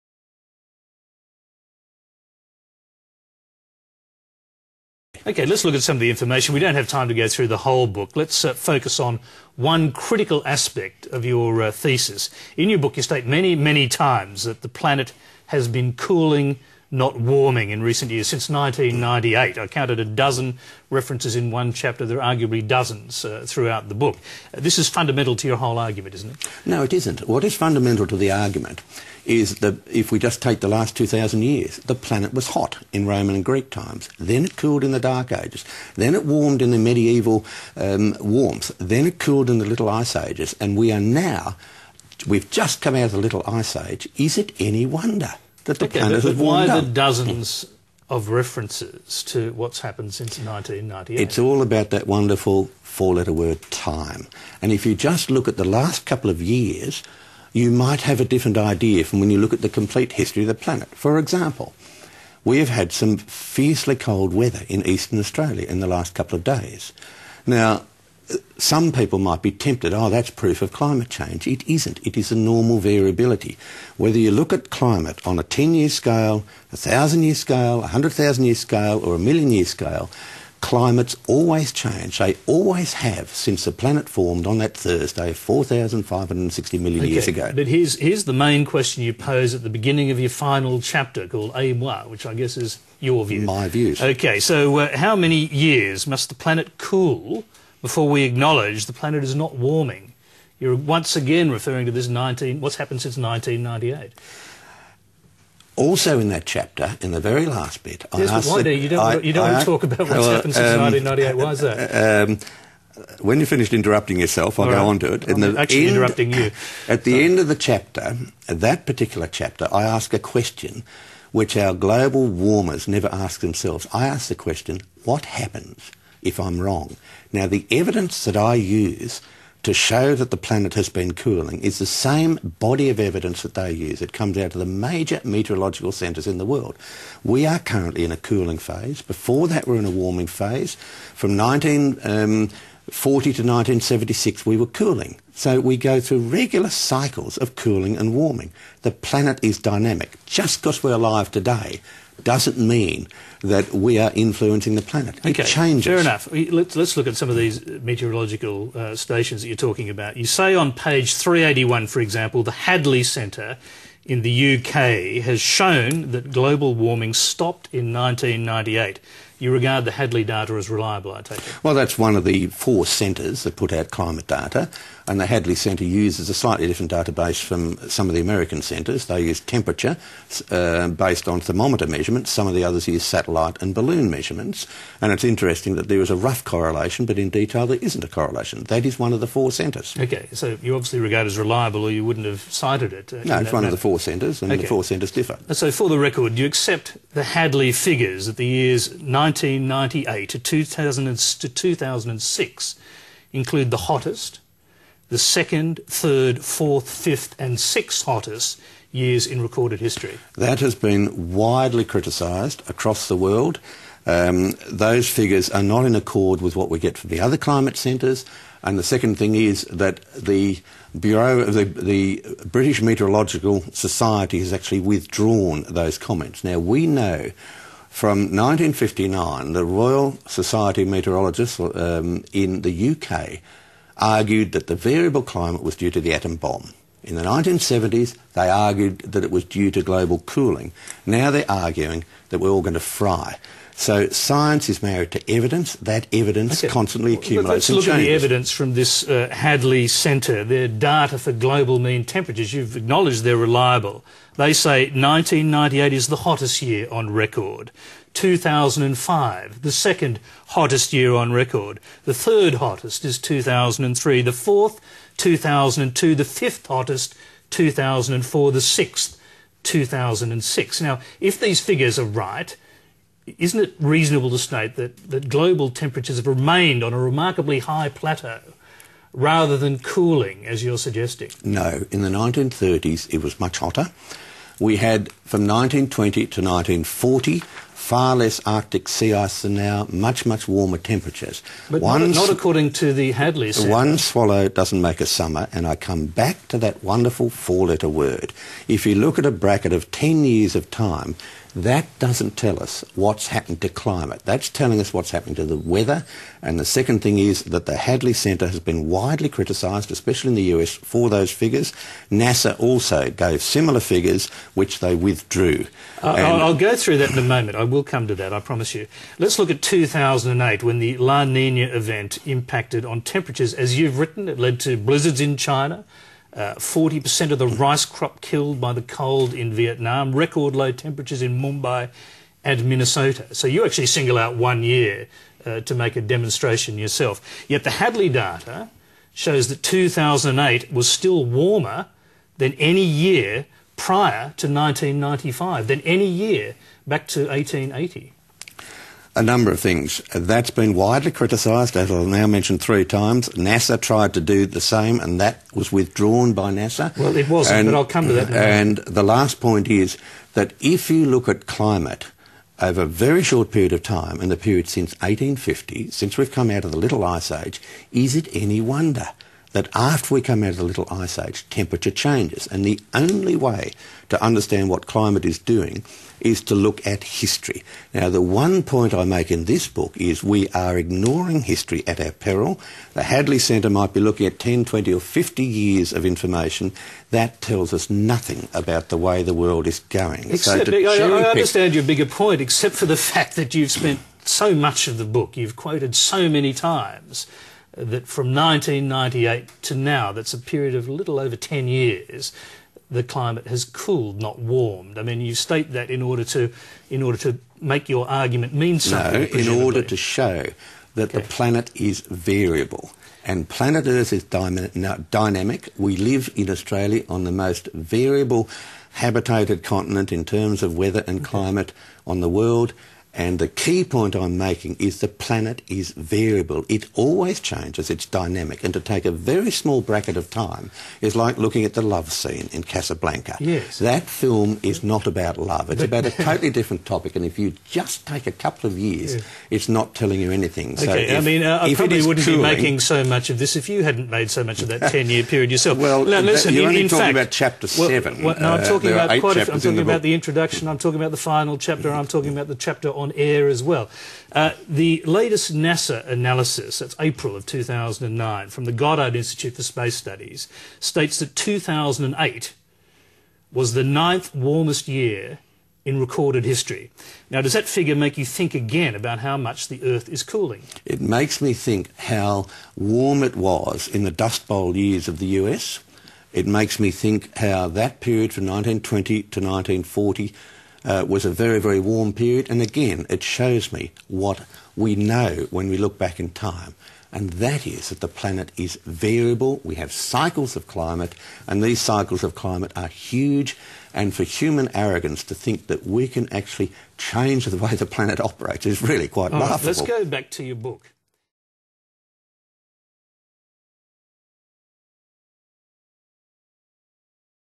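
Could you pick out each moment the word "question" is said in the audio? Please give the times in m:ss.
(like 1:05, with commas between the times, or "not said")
1:28, 2:00, 2:04.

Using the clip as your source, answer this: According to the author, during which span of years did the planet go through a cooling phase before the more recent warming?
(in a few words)
1940 to 1976.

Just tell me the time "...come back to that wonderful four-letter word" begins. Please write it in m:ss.
4:55.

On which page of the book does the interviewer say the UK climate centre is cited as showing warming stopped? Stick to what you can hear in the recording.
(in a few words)
381.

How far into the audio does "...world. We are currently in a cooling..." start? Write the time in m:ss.
2:16.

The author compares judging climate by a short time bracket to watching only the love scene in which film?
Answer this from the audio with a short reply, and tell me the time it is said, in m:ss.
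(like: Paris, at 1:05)
Casablanca, at 7:12.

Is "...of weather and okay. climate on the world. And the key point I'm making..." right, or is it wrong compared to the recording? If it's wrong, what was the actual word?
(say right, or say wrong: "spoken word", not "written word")
right.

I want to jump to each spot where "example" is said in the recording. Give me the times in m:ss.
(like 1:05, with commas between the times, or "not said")
1:01, 2:42.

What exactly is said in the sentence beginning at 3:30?
That has been widely criticised across the world.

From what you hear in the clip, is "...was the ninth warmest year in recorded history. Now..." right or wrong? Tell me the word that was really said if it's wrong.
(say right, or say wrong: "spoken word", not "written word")
right.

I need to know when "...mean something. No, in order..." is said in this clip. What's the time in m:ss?
6:48.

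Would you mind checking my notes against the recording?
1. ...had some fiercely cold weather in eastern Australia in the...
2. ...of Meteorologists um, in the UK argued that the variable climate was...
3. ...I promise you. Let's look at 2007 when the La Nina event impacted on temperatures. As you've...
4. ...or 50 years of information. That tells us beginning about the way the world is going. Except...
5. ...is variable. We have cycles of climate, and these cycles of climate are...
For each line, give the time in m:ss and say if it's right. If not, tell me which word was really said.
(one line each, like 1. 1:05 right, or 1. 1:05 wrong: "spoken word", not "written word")
1. 1:02 right
2. 3:50 right
3. 5:18 wrong: "2008", not "2007"
4. 6:24 wrong: "nothing", not "beginning"
5. 8:08 right.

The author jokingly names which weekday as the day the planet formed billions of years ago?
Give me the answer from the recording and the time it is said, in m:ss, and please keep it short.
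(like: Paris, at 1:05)
Thursday, at 1:24.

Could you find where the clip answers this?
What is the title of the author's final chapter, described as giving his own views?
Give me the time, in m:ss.
1:31.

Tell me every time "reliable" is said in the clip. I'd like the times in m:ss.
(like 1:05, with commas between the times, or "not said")
2:50, 3:11, 4:13.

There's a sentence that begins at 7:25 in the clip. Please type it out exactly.
Well, now, listen, you're in, only in talking fact, about chapter well, 7.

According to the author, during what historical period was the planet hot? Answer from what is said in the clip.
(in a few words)
Roman and Greek times.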